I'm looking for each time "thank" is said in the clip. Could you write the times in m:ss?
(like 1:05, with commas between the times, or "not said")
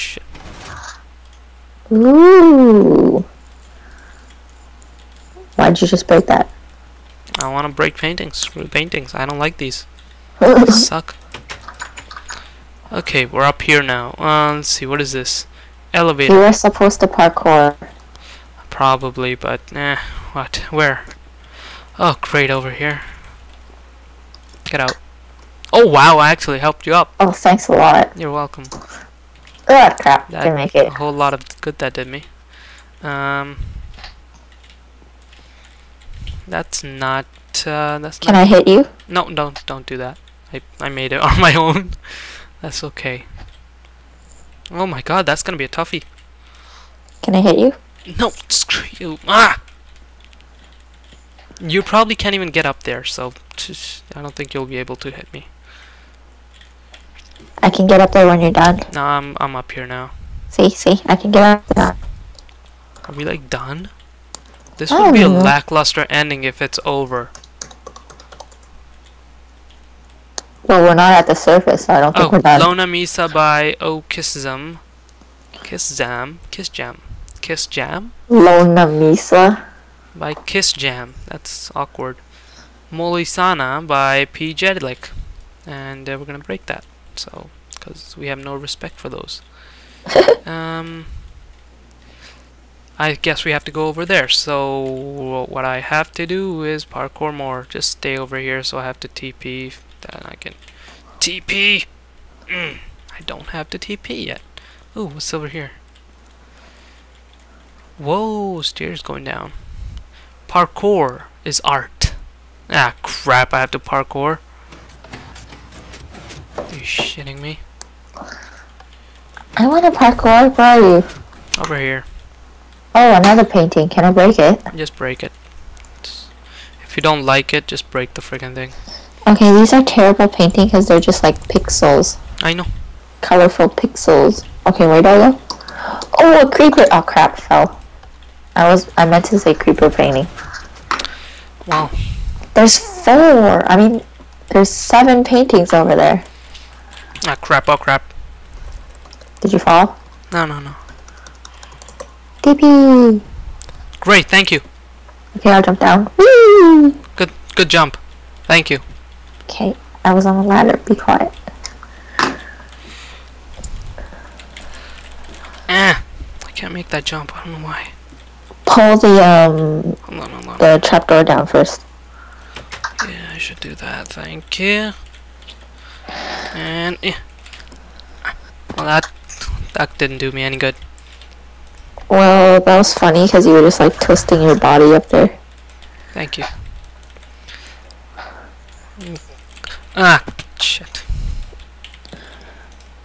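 0:27, 2:34, 2:38, 2:54, 3:06.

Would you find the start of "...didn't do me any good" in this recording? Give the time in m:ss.
2:59.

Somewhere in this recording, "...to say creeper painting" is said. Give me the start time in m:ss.
2:19.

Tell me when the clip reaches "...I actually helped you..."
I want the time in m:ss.
0:26.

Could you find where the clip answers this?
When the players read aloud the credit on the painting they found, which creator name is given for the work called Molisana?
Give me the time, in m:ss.
1:24.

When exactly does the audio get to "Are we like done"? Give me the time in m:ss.
1:03.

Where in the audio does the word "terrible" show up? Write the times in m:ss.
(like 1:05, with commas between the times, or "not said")
2:09.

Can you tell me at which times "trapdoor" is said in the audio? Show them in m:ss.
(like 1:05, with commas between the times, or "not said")
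2:50.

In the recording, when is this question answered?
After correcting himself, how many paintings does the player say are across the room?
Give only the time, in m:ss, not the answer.
2:24.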